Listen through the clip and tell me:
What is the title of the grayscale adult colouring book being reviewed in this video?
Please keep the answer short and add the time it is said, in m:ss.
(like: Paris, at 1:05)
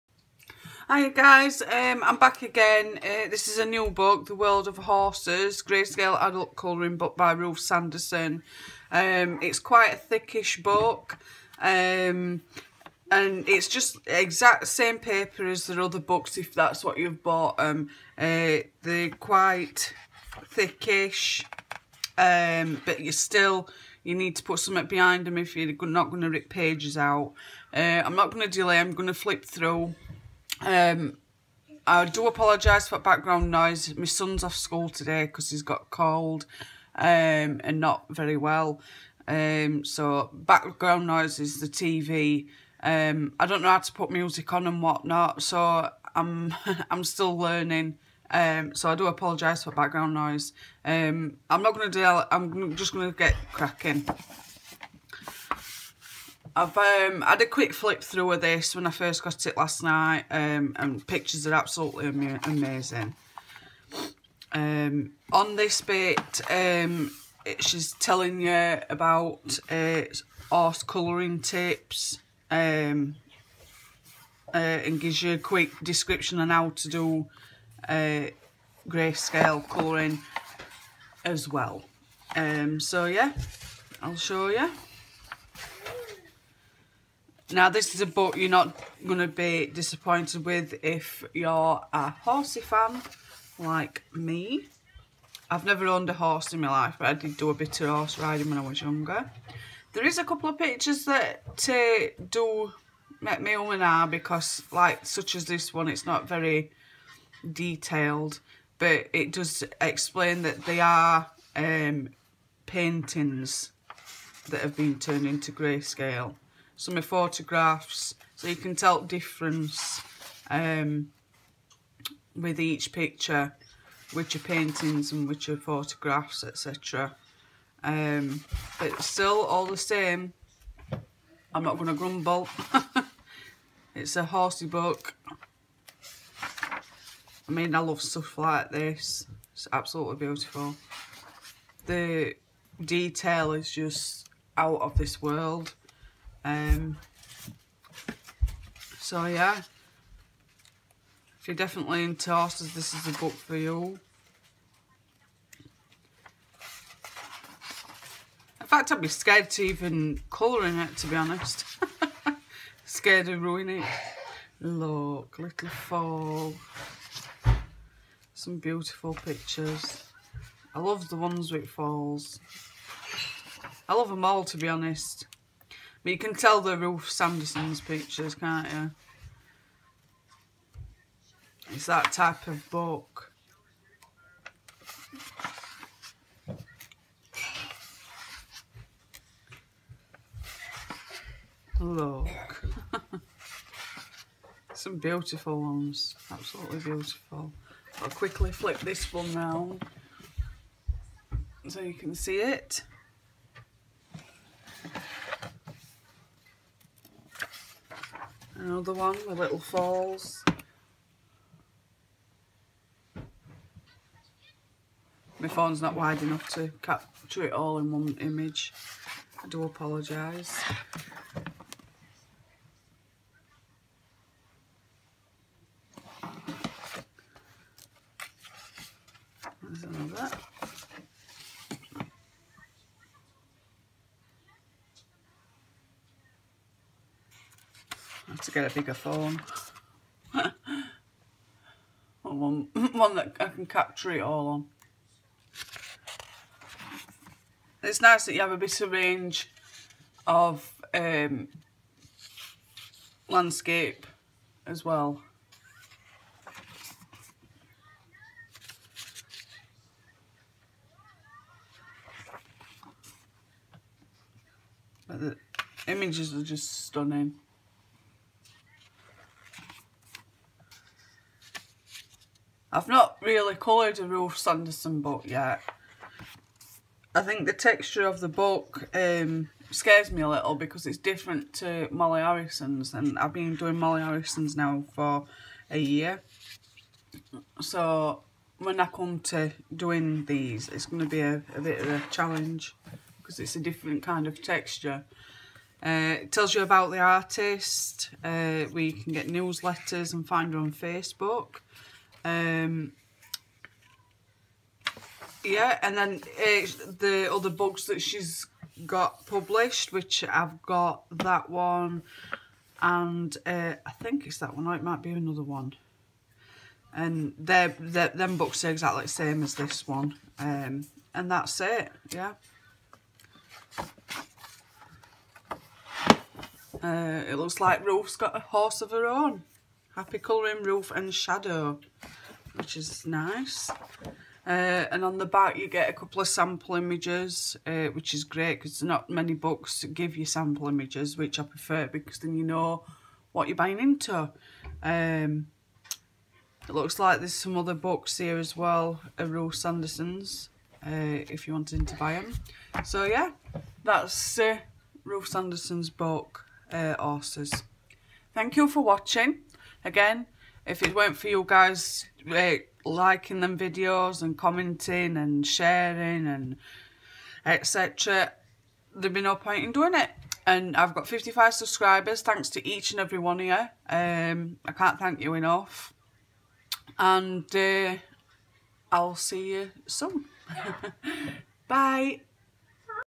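The World of Horses, at 0:04.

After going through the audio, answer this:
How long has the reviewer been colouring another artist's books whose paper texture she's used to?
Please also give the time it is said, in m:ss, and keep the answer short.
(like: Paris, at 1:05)
a year, at 4:45.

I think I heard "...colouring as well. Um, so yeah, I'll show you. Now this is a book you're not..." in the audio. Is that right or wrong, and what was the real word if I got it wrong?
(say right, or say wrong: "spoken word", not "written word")
right.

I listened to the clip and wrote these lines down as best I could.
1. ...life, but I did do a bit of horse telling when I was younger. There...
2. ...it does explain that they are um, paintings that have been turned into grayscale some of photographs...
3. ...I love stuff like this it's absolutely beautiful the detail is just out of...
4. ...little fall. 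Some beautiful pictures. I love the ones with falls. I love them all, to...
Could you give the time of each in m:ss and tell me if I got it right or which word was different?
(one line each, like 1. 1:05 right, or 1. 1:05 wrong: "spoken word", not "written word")
1. 1:36 wrong: "riding", not "telling"
2. 1:49 right
3. 2:17 right
4. 2:45 right.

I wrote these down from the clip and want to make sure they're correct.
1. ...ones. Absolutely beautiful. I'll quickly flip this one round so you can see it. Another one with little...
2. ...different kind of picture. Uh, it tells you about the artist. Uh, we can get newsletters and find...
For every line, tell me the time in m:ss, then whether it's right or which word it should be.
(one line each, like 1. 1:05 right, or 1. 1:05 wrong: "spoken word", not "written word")
1. 3:15 right
2. 4:53 wrong: "texture", not "picture".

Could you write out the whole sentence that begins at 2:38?
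In fact, I'd be scared to even colouring it, to be honest.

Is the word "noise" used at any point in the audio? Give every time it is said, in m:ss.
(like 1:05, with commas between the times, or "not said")
0:33, 0:41, 0:50.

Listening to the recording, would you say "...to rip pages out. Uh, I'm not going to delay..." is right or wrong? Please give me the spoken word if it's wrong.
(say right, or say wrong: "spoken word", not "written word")
right.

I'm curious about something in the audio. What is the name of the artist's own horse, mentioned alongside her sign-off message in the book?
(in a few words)
Shadow.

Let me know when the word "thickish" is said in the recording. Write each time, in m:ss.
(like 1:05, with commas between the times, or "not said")
0:09, 0:20.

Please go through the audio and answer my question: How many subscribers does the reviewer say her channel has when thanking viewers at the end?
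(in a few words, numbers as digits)
55.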